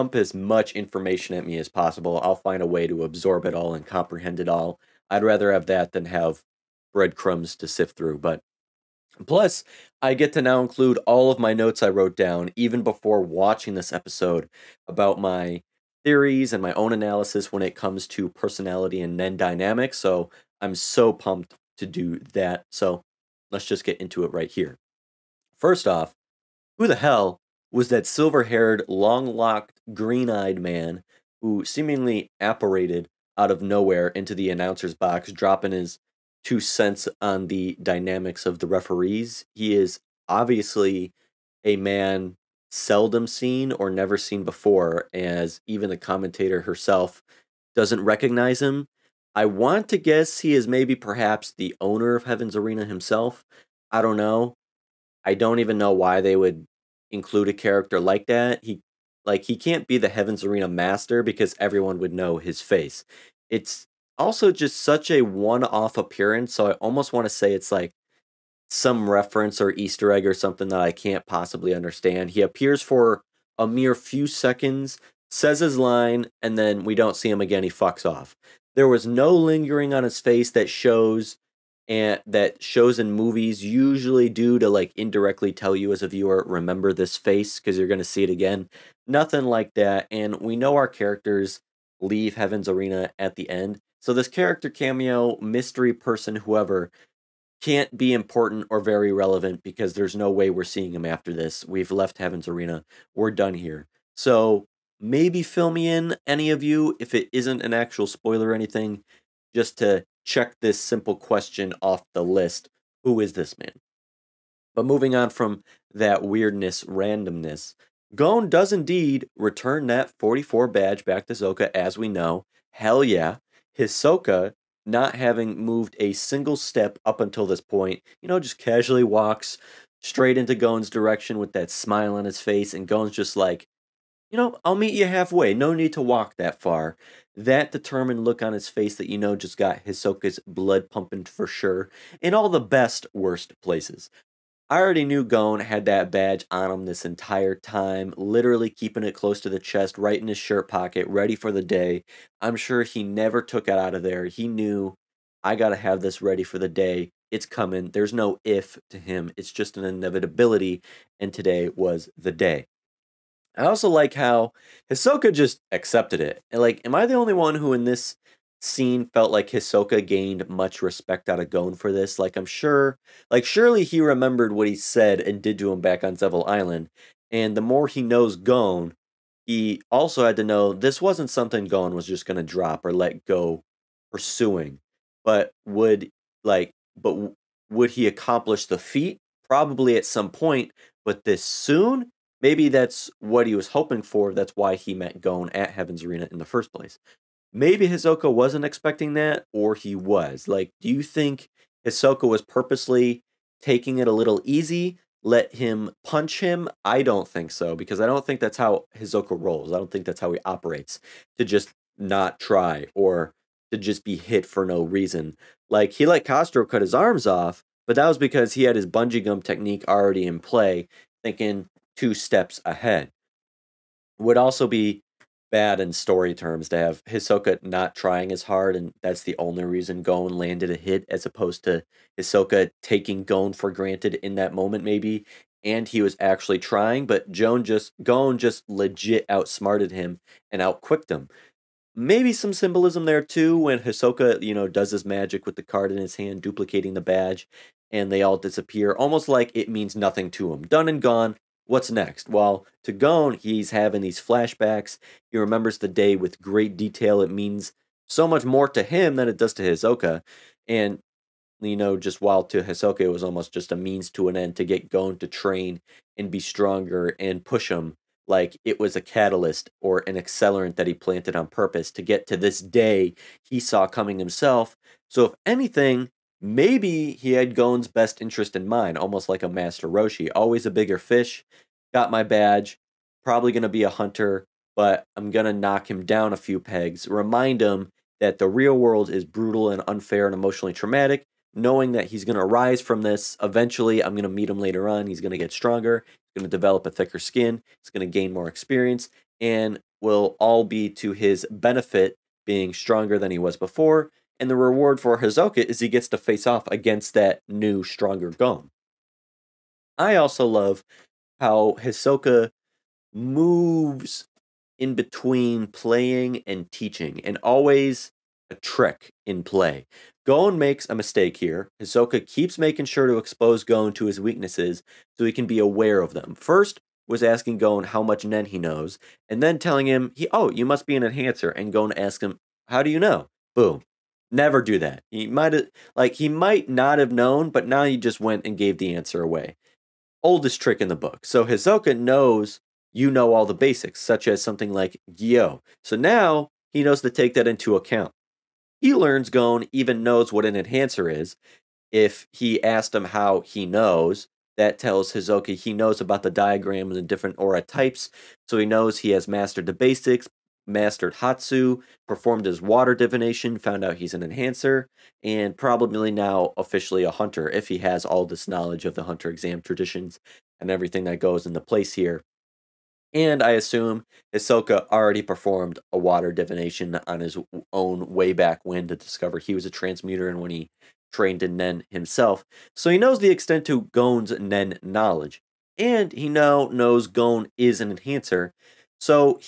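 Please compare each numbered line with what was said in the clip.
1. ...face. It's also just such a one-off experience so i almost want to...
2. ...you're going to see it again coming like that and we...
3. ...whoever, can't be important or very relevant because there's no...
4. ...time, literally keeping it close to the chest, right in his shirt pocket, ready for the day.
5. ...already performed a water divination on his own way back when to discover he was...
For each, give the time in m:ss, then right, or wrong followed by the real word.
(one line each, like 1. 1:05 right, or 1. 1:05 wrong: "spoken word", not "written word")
1. 1:02 wrong: "appearance", not "experience"
2. 1:27 wrong: "nothing", not "coming"
3. 1:36 right
4. 2:27 right
5. 6:14 right.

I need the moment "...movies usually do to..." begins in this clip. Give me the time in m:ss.
1:23.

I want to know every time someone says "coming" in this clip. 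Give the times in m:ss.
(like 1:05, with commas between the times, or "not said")
2:37, 4:33.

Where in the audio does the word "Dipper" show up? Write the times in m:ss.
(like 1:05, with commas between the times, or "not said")
not said.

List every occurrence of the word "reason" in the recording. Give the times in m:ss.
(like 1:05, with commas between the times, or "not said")
3:34, 3:49.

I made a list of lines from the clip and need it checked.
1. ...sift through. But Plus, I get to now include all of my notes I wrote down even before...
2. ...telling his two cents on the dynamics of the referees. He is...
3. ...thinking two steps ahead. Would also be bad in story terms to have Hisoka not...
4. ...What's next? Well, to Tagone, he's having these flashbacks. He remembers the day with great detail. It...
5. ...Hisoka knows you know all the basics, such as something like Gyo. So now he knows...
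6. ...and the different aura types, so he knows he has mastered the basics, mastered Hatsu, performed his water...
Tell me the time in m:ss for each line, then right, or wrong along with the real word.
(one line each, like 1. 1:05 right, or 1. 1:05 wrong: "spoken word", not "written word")
1. 0:07 right
2. 0:35 wrong: "dropping", not "telling"
3. 3:41 right
4. 4:11 right
5. 5:41 right
6. 5:56 right.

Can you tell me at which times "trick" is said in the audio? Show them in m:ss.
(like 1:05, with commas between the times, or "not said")
5:18, 5:40.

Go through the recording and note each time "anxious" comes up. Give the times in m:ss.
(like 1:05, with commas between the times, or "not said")
not said.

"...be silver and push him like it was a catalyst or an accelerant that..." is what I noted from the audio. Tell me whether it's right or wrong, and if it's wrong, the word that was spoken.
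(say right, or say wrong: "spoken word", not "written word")
wrong: "stronger", not "silver".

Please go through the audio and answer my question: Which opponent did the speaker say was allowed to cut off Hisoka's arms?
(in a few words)
Castro.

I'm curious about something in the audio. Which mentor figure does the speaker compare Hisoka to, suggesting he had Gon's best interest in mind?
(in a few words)
Master Roshi.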